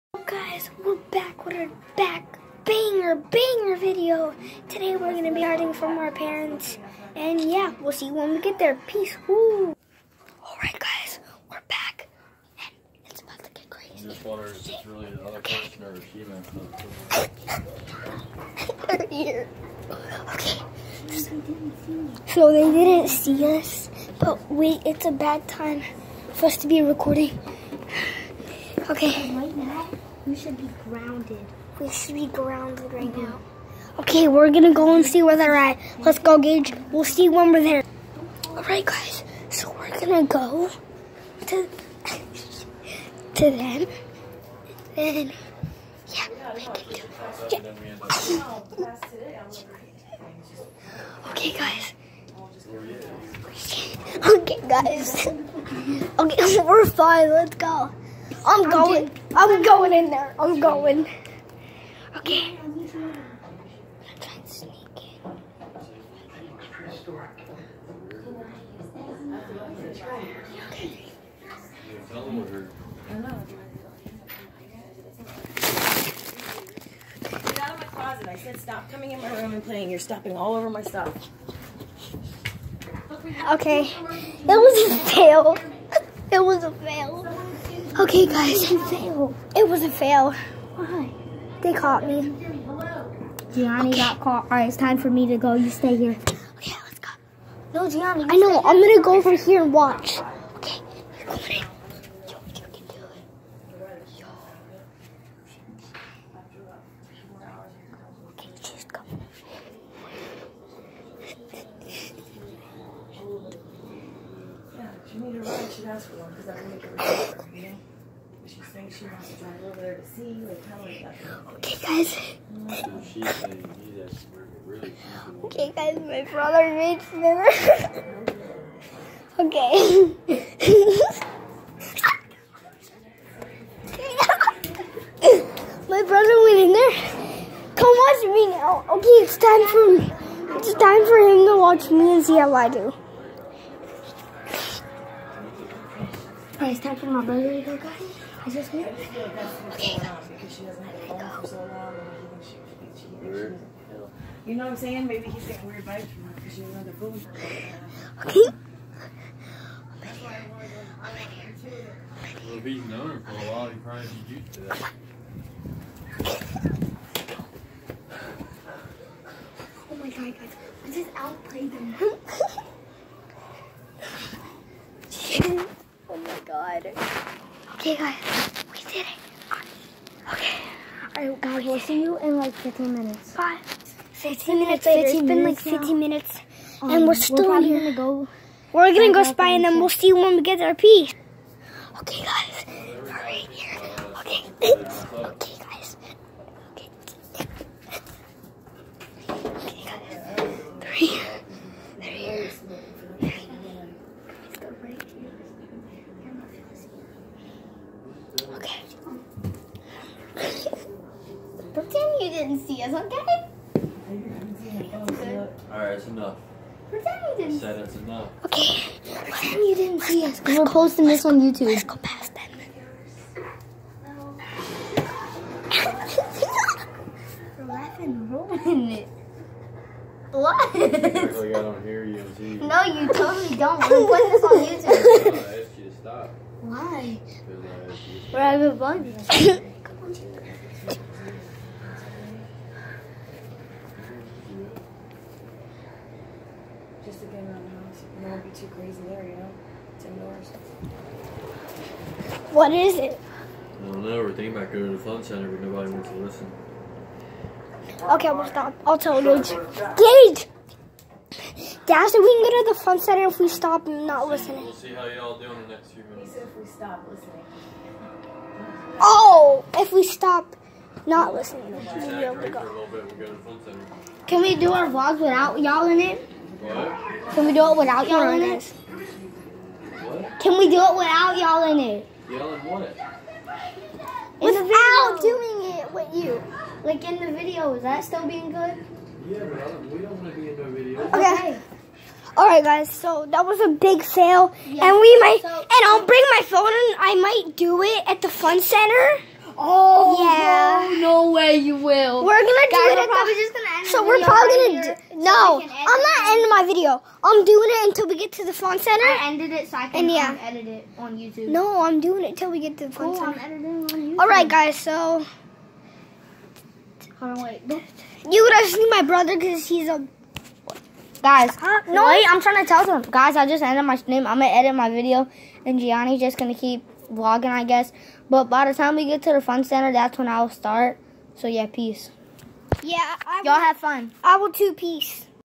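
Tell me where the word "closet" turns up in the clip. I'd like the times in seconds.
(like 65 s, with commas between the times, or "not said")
77 s.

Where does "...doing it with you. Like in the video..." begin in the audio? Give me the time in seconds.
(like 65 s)
285 s.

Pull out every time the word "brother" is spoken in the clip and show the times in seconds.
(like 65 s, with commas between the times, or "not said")
126 s, 136 s, 147 s, 319 s.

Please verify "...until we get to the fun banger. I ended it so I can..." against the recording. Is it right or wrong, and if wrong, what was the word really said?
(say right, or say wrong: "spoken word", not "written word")
wrong: "center", not "banger".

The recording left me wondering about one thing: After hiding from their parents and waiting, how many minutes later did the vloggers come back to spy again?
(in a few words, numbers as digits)
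15.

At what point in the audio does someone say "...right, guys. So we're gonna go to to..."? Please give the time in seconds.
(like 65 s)
38 s.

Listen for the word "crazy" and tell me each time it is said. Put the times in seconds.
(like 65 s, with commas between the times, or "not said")
13 s, 248 s.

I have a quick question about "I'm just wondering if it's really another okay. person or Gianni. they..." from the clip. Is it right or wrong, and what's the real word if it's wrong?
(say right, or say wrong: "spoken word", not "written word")
wrong: "Shima", not "Gianni".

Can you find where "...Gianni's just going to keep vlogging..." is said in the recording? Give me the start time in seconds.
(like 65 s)
325 s.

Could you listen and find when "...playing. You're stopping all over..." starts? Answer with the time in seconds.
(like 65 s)
79 s.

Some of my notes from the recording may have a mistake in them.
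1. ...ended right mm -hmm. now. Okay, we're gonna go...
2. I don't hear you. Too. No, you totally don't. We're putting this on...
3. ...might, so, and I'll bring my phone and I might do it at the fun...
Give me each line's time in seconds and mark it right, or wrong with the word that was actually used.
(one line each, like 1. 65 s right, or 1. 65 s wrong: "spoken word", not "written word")
1. 32 s wrong: "grounded", not "ended"
2. 230 s right
3. 295 s right.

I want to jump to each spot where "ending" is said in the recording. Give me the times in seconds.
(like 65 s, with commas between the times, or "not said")
306 s.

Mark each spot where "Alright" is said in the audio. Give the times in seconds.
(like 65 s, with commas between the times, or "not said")
215 s, 292 s, 314 s.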